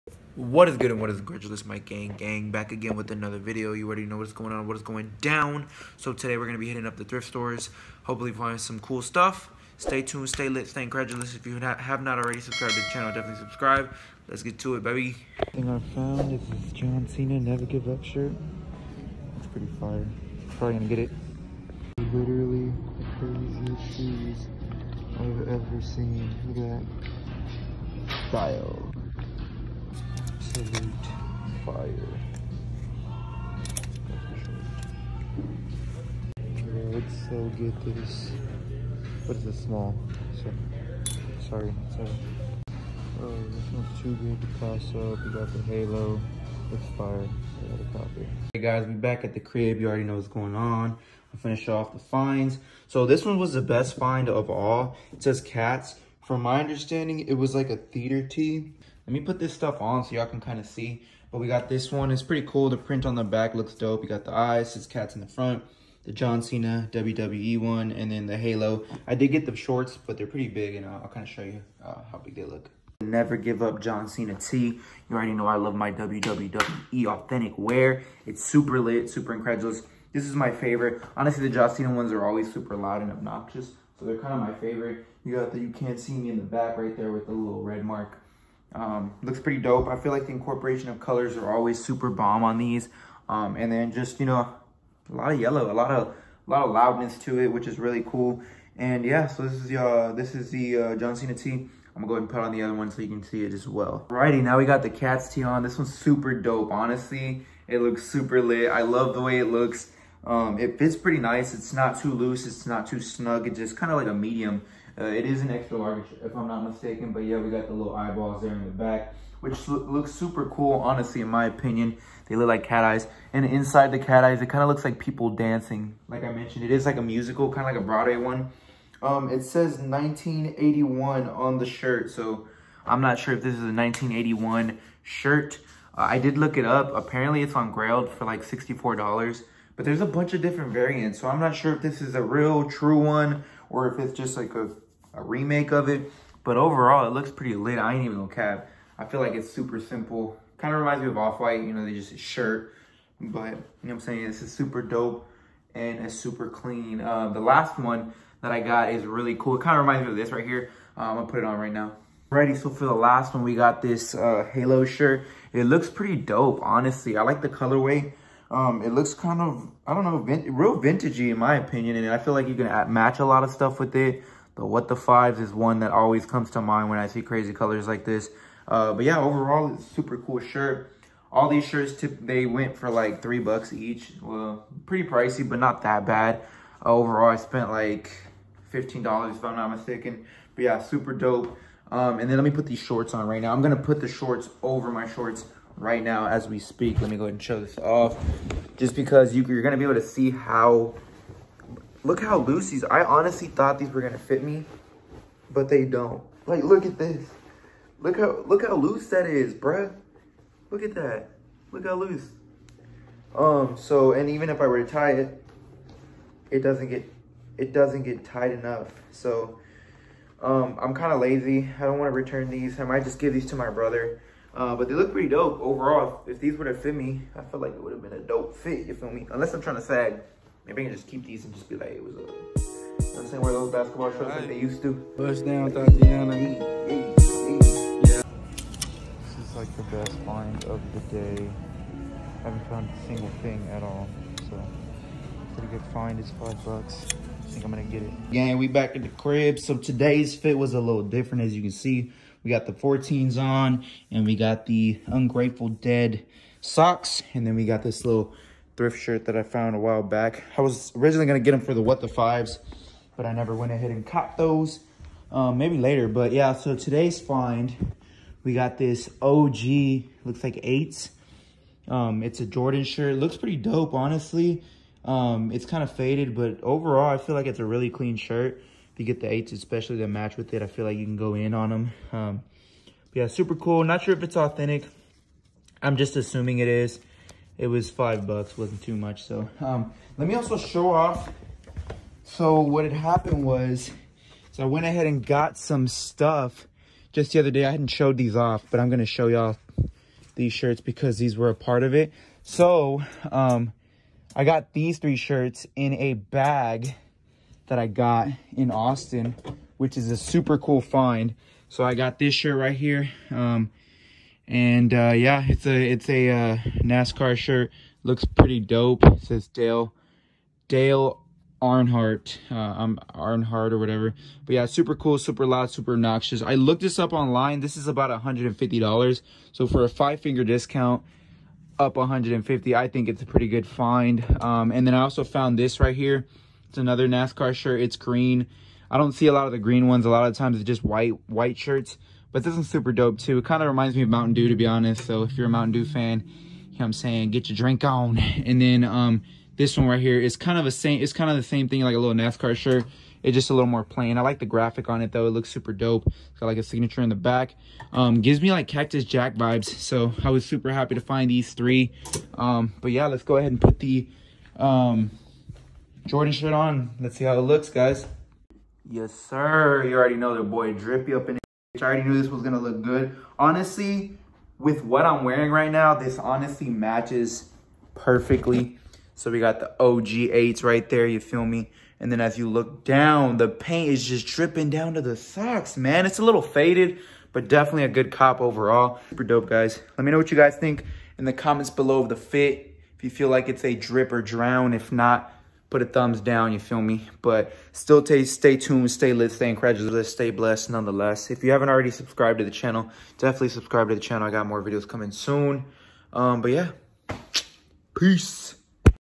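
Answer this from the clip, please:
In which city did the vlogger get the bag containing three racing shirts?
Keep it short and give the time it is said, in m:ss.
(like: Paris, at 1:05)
Austin, at 5:08.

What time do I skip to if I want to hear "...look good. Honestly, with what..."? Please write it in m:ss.
6:12.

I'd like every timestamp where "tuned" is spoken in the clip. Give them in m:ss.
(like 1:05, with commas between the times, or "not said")
0:10, 6:38.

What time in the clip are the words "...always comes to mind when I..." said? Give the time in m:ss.
2:55.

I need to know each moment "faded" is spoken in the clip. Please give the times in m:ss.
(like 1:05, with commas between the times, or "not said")
4:35, 6:26.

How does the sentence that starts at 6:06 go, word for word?
Let's see how it looks, guys.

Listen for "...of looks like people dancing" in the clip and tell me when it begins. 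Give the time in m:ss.
2:04.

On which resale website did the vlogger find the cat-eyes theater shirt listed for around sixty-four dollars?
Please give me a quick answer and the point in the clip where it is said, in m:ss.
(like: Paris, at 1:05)
Grailed, at 2:17.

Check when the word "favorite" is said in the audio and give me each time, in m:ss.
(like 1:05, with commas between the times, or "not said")
1:20, 1:24.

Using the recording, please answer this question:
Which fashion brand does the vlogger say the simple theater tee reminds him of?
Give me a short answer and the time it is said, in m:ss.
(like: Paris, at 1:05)
Off-White, at 2:31.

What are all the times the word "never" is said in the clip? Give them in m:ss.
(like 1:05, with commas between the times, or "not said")
0:17, 1:13, 4:23.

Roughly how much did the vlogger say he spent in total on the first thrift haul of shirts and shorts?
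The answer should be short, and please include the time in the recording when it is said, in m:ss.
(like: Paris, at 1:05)
$15, at 3:08.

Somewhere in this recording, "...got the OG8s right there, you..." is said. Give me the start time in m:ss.
6:19.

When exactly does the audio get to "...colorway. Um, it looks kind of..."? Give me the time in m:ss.
2:47.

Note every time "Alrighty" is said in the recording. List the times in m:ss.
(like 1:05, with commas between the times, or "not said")
1:44, 2:42.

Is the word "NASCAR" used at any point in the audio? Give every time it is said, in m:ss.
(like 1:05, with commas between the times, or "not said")
5:16, 5:37, 5:52.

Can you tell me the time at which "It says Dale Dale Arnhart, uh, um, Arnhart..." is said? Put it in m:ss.
5:19.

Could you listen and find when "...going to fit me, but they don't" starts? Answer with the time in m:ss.
3:24.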